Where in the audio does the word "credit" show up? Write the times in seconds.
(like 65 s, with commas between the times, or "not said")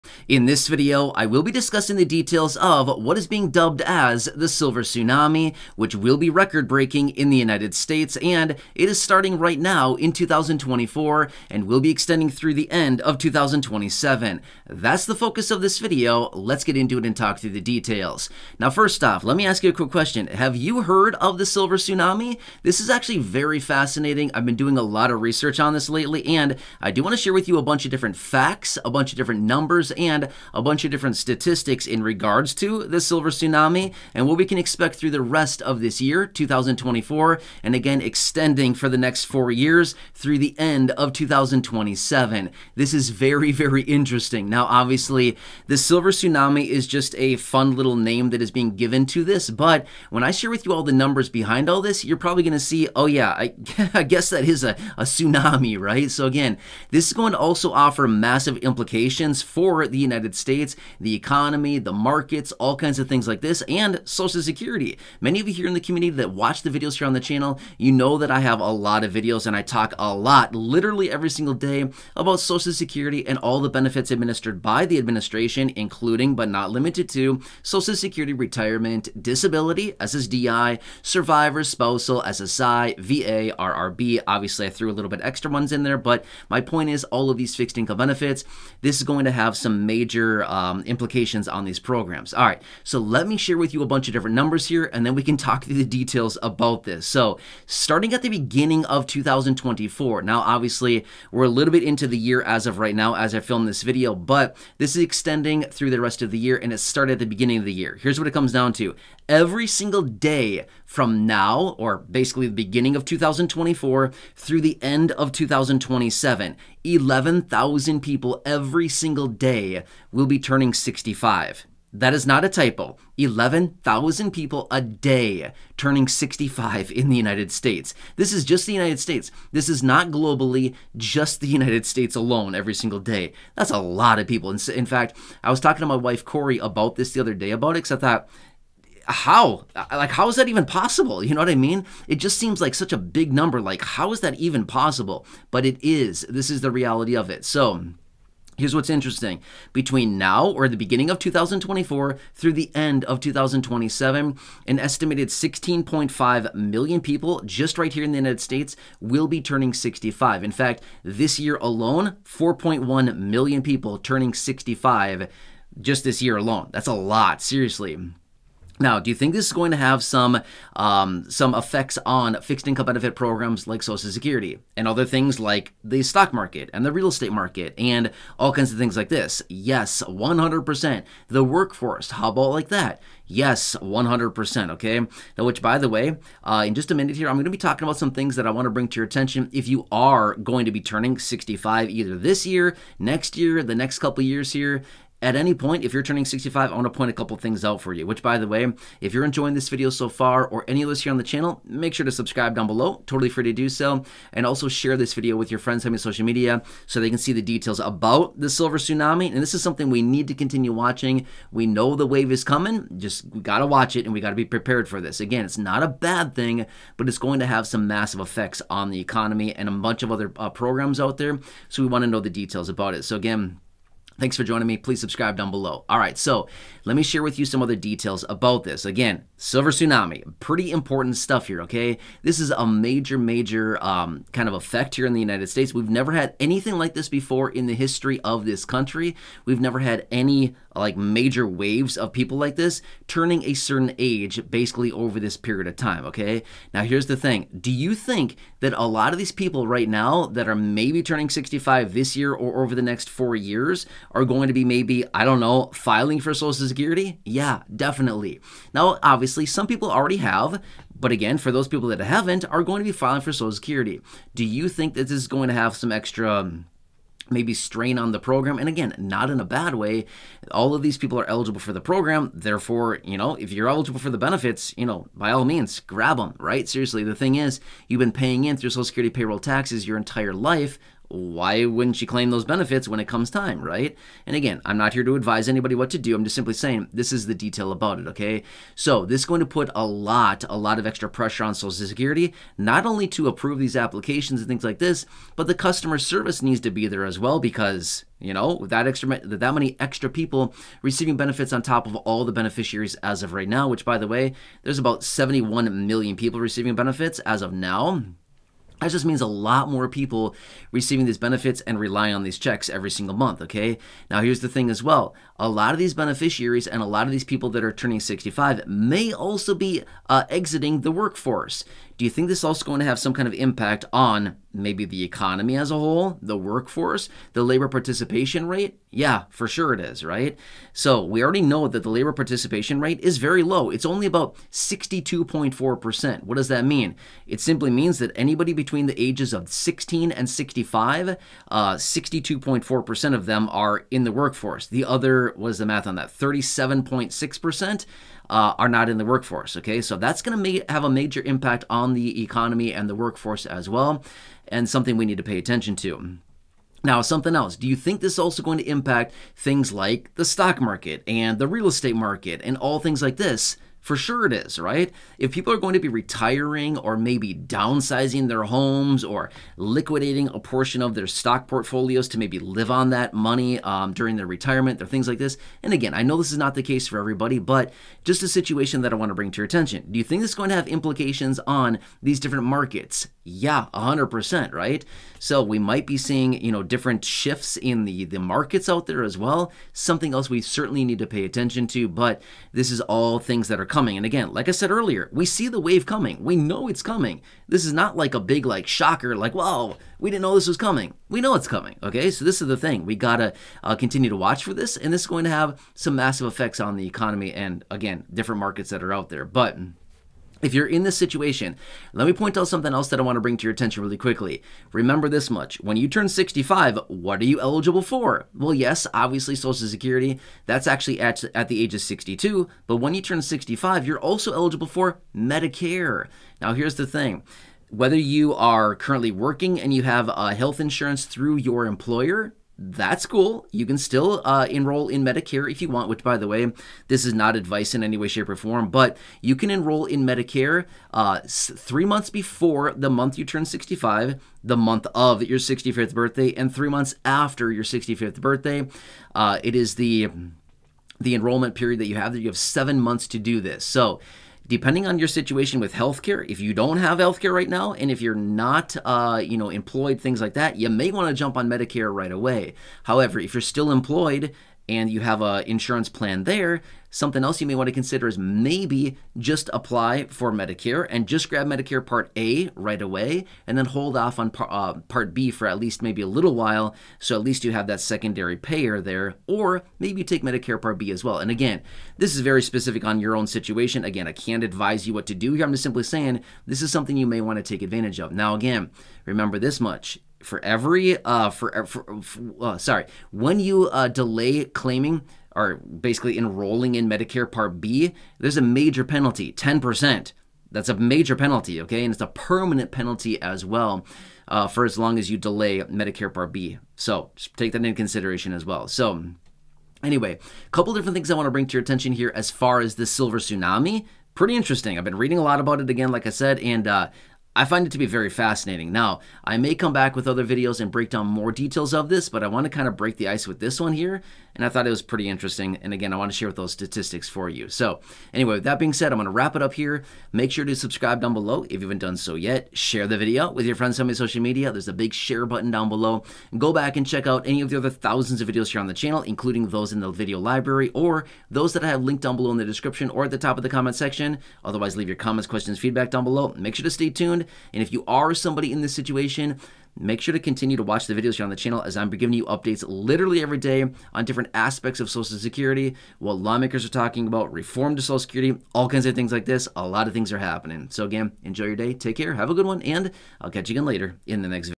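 not said.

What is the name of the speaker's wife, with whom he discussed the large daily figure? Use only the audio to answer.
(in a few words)
Corey.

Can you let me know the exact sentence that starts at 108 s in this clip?
Here's what it comes down to.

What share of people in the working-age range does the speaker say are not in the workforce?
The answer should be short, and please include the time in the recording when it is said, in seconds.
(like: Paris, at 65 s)
37.6%, at 346 s.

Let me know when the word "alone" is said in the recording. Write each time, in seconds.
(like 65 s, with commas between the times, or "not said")
132 s, 161 s, 166 s.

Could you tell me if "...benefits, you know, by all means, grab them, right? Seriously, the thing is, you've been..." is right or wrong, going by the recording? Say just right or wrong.
right.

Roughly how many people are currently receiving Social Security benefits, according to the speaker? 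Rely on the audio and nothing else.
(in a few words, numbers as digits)
71 million.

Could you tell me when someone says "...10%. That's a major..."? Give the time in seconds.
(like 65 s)
499 s.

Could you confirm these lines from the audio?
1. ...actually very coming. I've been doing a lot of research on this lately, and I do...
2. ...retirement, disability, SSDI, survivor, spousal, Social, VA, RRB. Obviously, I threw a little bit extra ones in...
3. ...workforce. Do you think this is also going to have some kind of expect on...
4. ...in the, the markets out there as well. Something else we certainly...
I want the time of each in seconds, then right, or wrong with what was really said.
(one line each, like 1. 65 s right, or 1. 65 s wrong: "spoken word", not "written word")
1. 22 s wrong: "fascinating", not "coming"
2. 78 s wrong: "SSI", not "Social"
3. 320 s wrong: "impact", not "expect"
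4. 387 s right.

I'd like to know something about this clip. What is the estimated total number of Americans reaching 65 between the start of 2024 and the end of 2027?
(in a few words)
16.5 million.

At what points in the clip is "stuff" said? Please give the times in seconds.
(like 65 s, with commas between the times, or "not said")
231 s.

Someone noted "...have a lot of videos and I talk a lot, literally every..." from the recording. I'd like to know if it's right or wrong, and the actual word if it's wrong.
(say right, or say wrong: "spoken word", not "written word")
right.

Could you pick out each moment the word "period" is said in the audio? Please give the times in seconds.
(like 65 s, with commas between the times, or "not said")
245 s, 451 s.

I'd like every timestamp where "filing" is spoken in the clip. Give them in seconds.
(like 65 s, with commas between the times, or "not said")
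255 s, 262 s.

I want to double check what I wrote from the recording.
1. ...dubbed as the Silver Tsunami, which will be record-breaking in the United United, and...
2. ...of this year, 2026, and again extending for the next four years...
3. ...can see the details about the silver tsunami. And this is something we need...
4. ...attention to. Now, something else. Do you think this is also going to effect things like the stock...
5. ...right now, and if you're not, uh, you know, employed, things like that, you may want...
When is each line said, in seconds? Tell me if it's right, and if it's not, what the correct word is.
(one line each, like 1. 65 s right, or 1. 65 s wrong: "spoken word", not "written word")
1. 3 s wrong: "States", not "United"
2. 35 s wrong: "2024", not "2026"
3. 207 s right
4. 355 s wrong: "impact", not "effect"
5. 457 s right.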